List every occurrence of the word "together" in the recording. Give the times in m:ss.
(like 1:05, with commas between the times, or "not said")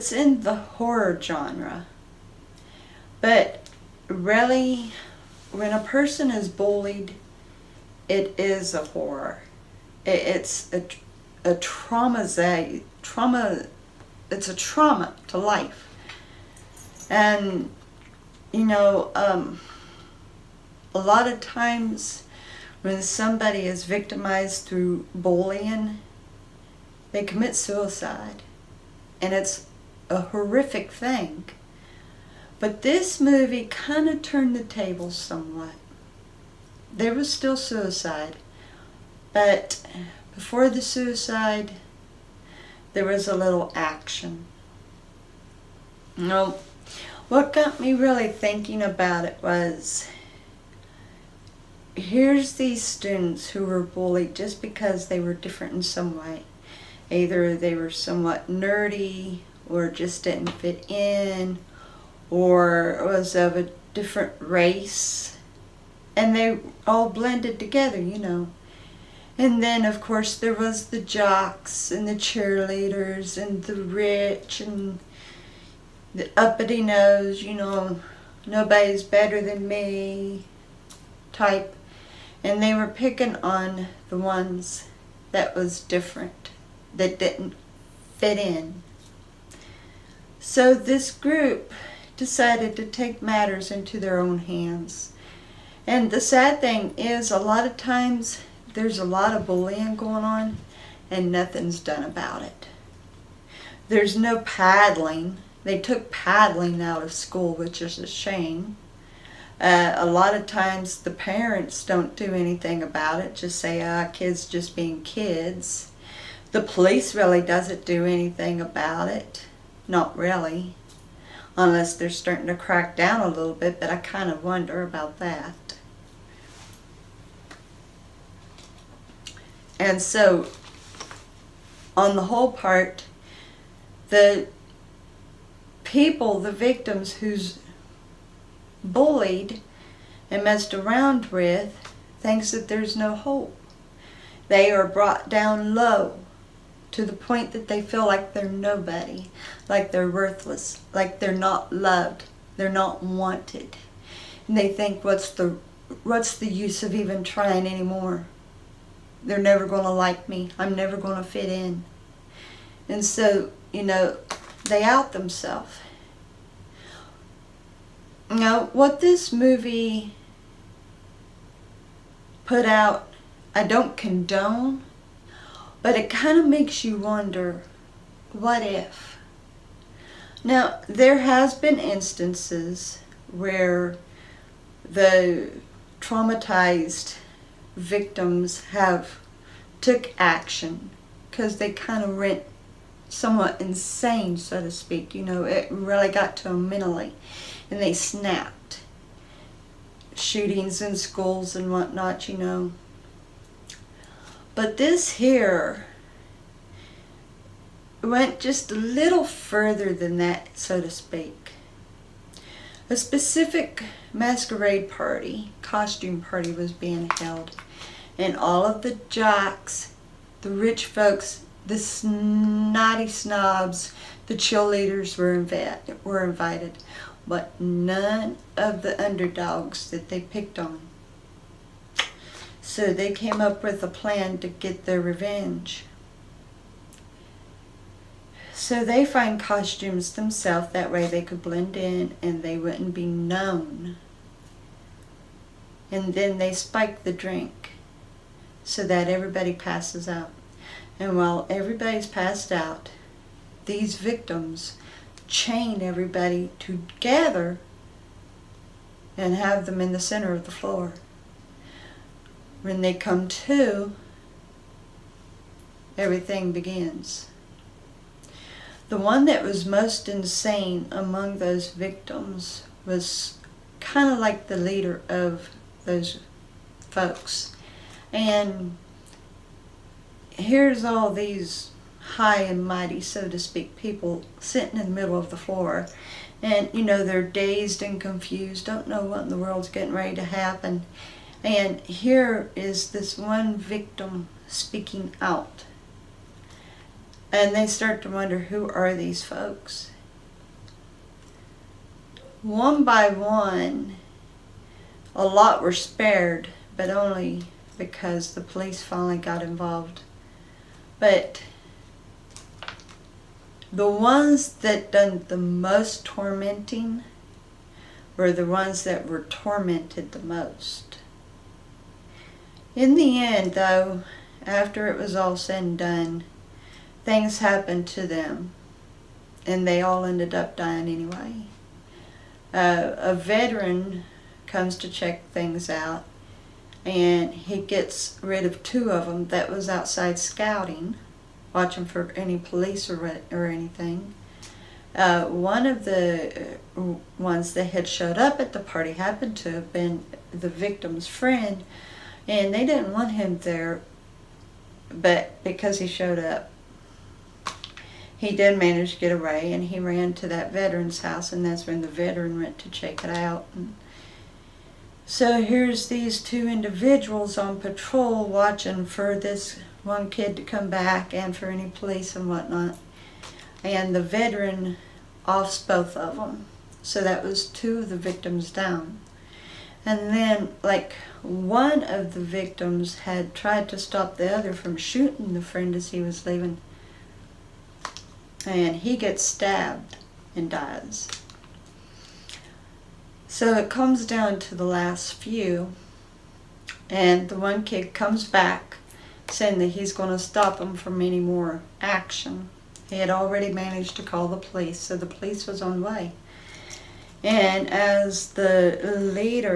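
1:07, 4:16.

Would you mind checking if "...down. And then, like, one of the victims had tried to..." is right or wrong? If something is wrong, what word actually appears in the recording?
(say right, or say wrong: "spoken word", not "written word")
right.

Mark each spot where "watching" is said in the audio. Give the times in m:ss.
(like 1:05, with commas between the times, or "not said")
5:41, 6:08.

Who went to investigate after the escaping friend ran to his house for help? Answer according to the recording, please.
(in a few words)
A veteran.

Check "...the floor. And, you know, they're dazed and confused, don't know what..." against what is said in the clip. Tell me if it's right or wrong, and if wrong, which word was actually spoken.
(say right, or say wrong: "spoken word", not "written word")
right.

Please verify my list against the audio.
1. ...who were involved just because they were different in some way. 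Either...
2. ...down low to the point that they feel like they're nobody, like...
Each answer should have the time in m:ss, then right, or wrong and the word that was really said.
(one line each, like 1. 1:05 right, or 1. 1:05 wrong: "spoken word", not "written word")
1. 0:53 wrong: "bullied", not "involved"
2. 2:25 right.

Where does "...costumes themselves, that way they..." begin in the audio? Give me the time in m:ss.
3:59.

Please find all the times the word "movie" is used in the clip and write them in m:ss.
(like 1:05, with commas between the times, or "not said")
0:33, 2:49.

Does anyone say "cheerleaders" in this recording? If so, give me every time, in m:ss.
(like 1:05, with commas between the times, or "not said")
1:12, 3:44.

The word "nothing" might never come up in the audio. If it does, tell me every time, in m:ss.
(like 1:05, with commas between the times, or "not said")
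1:41.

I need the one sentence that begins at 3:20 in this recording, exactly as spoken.
Shootings in schools and whatnot, you know.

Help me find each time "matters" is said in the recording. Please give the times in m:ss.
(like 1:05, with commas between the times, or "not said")
1:33.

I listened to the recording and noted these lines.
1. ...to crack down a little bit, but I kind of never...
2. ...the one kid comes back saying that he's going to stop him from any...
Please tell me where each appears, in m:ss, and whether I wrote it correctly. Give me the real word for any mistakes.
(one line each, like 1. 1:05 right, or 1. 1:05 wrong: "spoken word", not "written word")
1. 2:02 wrong: "wonder", not "never"
2. 6:37 right.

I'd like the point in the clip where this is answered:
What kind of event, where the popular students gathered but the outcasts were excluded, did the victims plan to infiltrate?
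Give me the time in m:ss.
3:34.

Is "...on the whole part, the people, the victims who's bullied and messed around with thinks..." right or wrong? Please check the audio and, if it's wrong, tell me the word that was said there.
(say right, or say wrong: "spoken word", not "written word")
right.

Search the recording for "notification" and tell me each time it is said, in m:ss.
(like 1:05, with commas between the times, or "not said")
not said.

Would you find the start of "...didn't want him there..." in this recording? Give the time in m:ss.
5:52.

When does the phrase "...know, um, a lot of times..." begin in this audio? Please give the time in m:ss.
0:18.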